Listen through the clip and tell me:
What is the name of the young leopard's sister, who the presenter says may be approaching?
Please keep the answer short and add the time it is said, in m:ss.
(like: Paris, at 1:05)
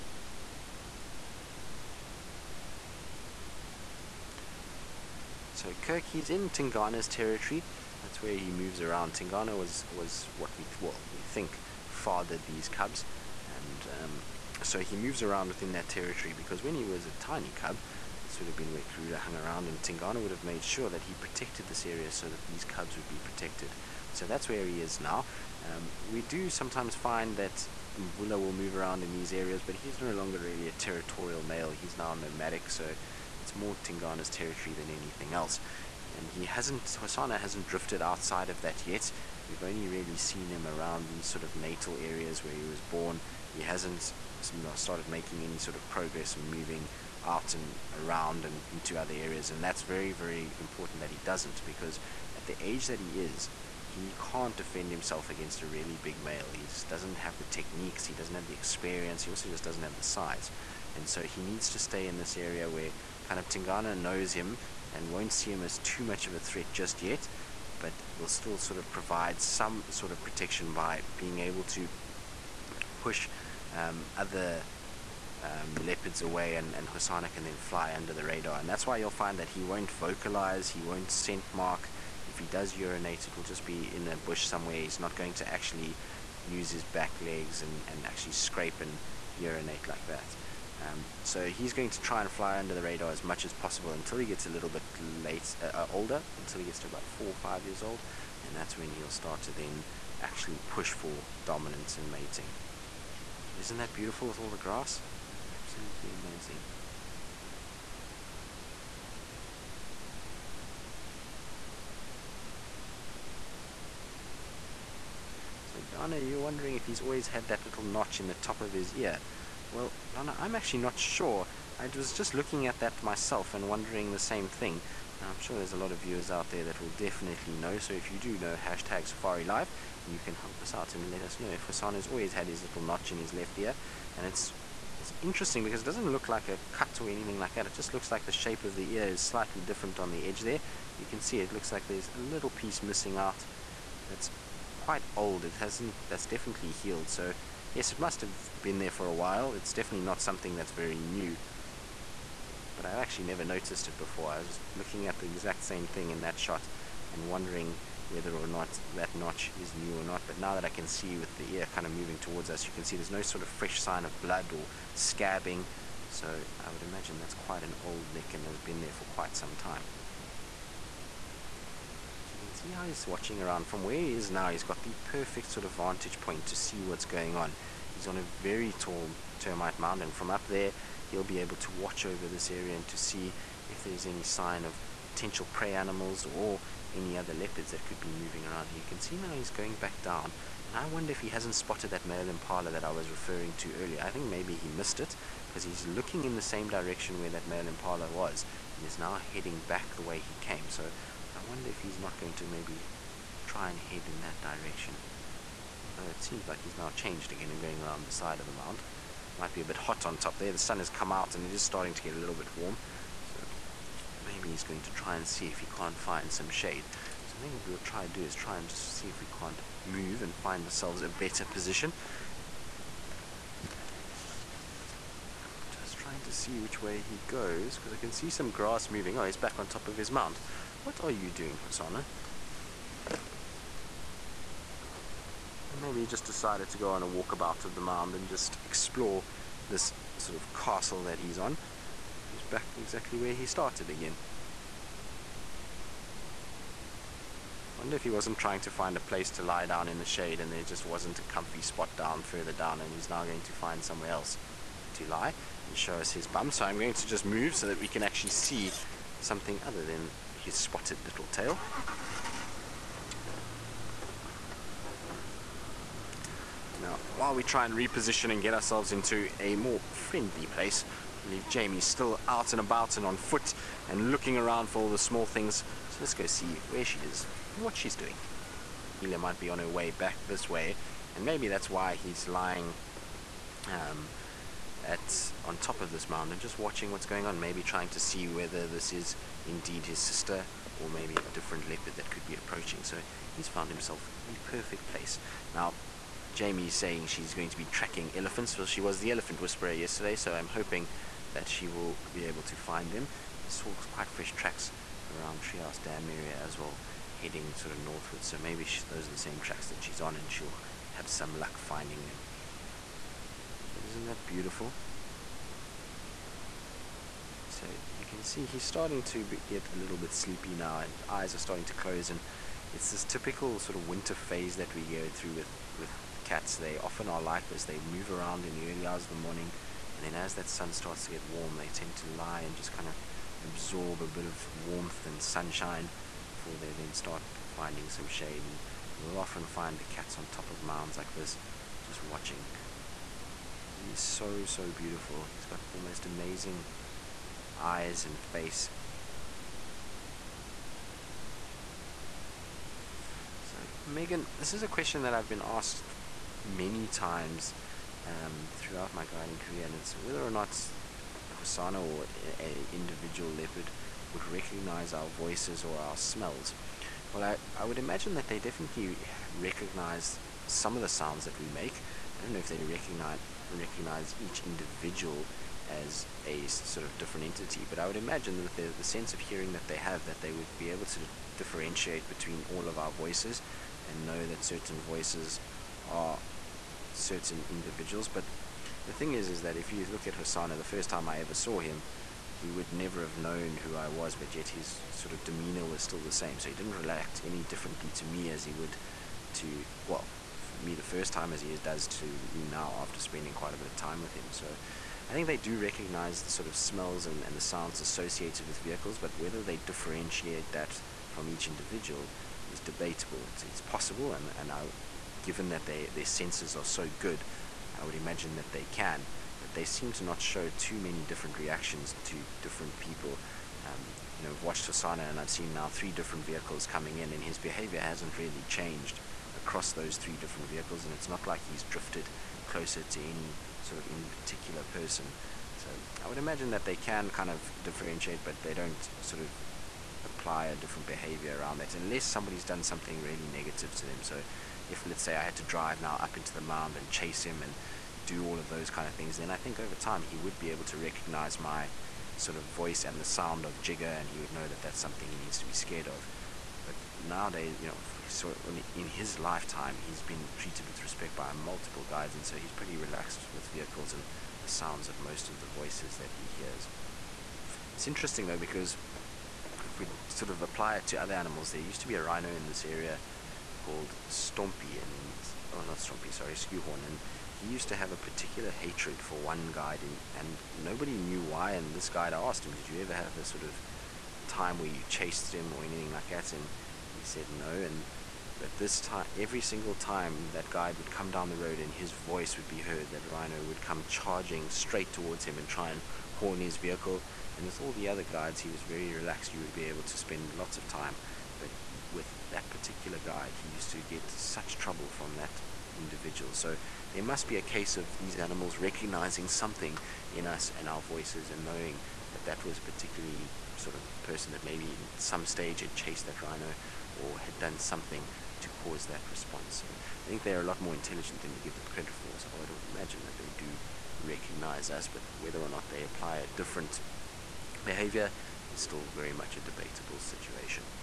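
Elia, at 4:39.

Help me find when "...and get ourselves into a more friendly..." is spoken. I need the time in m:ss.
4:28.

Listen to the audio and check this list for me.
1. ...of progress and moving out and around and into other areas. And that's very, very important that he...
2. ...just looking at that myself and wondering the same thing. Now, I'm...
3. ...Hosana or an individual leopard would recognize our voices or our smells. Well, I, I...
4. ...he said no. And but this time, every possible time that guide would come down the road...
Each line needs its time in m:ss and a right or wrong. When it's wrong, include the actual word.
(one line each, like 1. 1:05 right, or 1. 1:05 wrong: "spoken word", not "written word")
1. 0:45 right
2. 2:02 right
3. 6:01 right
4. 8:06 wrong: "single", not "possible".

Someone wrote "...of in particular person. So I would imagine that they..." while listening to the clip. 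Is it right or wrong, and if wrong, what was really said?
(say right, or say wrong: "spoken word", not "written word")
right.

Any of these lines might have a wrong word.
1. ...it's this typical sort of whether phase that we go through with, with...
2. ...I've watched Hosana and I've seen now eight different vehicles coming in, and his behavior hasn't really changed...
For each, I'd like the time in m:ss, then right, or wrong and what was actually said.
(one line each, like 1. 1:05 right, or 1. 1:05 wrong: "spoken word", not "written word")
1. 5:22 wrong: "winter", not "whether"
2. 7:04 wrong: "three", not "eight".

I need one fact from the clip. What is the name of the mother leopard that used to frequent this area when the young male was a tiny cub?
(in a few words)
Karula.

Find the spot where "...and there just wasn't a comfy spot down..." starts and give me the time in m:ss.
4:10.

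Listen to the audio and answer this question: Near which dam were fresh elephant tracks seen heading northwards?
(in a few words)
Trias Dam.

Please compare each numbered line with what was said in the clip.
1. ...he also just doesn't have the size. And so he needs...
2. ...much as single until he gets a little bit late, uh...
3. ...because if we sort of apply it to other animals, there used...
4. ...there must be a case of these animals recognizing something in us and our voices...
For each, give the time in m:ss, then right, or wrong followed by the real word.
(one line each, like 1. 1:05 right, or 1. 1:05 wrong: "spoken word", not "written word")
1. 0:59 right
2. 1:33 wrong: "possible", not "single"
3. 7:48 right
4. 8:26 right.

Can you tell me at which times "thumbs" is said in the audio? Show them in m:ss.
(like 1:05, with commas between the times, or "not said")
not said.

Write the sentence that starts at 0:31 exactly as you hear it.
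He's now nomadic, so it's more Tingana's territory than anything else.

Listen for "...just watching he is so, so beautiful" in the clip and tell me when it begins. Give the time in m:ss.
5:41.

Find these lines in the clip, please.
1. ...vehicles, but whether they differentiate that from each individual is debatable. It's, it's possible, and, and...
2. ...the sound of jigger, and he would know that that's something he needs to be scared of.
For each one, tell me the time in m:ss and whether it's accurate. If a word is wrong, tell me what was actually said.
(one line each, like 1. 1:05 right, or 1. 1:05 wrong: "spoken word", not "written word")
1. 6:48 right
2. 7:32 right.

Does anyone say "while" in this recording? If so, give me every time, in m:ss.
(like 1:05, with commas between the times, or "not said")
2:29, 4:27.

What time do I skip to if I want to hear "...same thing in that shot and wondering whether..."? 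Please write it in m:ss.
2:35.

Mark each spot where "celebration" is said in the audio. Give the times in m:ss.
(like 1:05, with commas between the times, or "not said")
not said.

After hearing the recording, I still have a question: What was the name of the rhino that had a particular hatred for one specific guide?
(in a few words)
Skewhorn.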